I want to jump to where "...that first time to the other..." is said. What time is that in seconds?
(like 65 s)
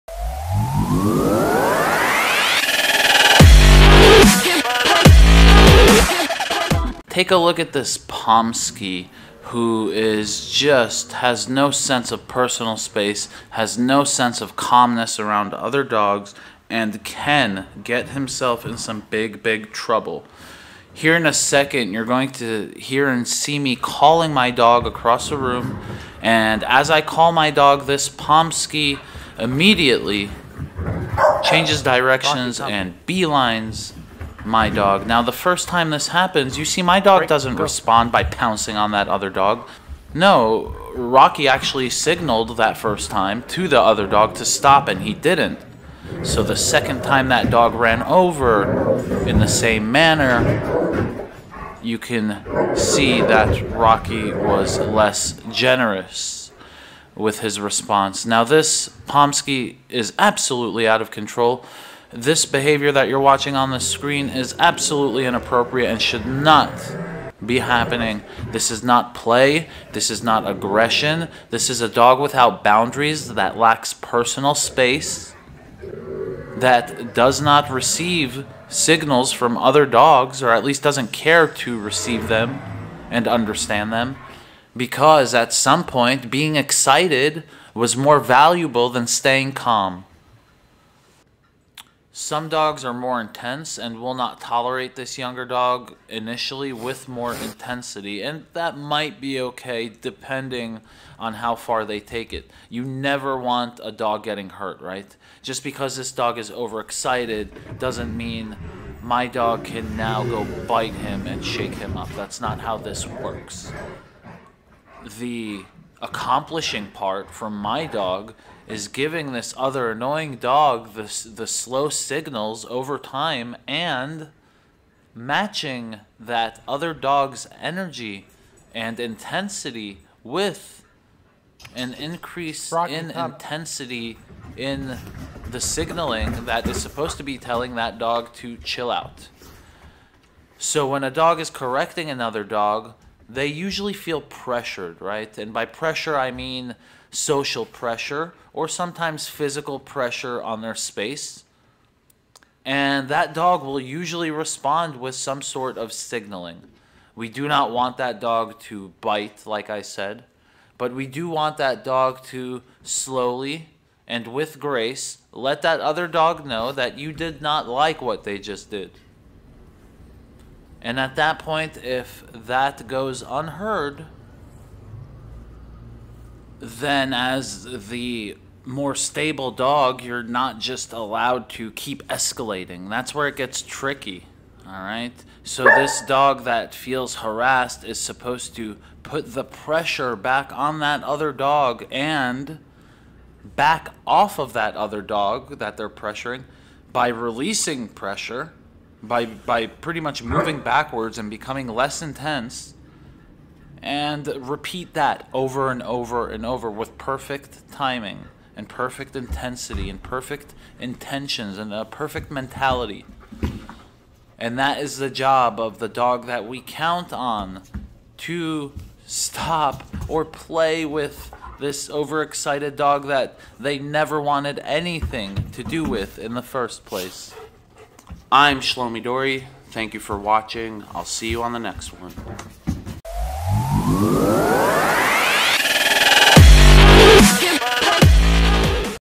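42 s.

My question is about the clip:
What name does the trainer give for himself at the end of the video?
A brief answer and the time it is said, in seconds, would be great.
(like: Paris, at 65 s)
Shlomi Dori, at 228 s.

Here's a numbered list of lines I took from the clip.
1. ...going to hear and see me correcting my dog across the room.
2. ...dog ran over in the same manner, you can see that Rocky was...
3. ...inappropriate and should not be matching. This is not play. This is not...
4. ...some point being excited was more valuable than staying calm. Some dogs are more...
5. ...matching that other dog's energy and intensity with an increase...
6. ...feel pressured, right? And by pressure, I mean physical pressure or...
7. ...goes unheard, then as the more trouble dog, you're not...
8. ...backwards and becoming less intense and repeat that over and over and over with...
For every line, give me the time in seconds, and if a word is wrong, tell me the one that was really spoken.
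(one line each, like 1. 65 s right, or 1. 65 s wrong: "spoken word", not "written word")
1. 22 s wrong: "calling", not "correcting"
2. 47 s right
3. 65 s wrong: "happening", not "matching"
4. 85 s right
5. 125 s right
6. 143 s wrong: "social", not "physical"
7. 172 s wrong: "stable", not "trouble"
8. 200 s right.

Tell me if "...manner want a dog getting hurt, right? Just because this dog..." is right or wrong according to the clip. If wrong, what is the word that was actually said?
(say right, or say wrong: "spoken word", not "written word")
wrong: "never", not "manner".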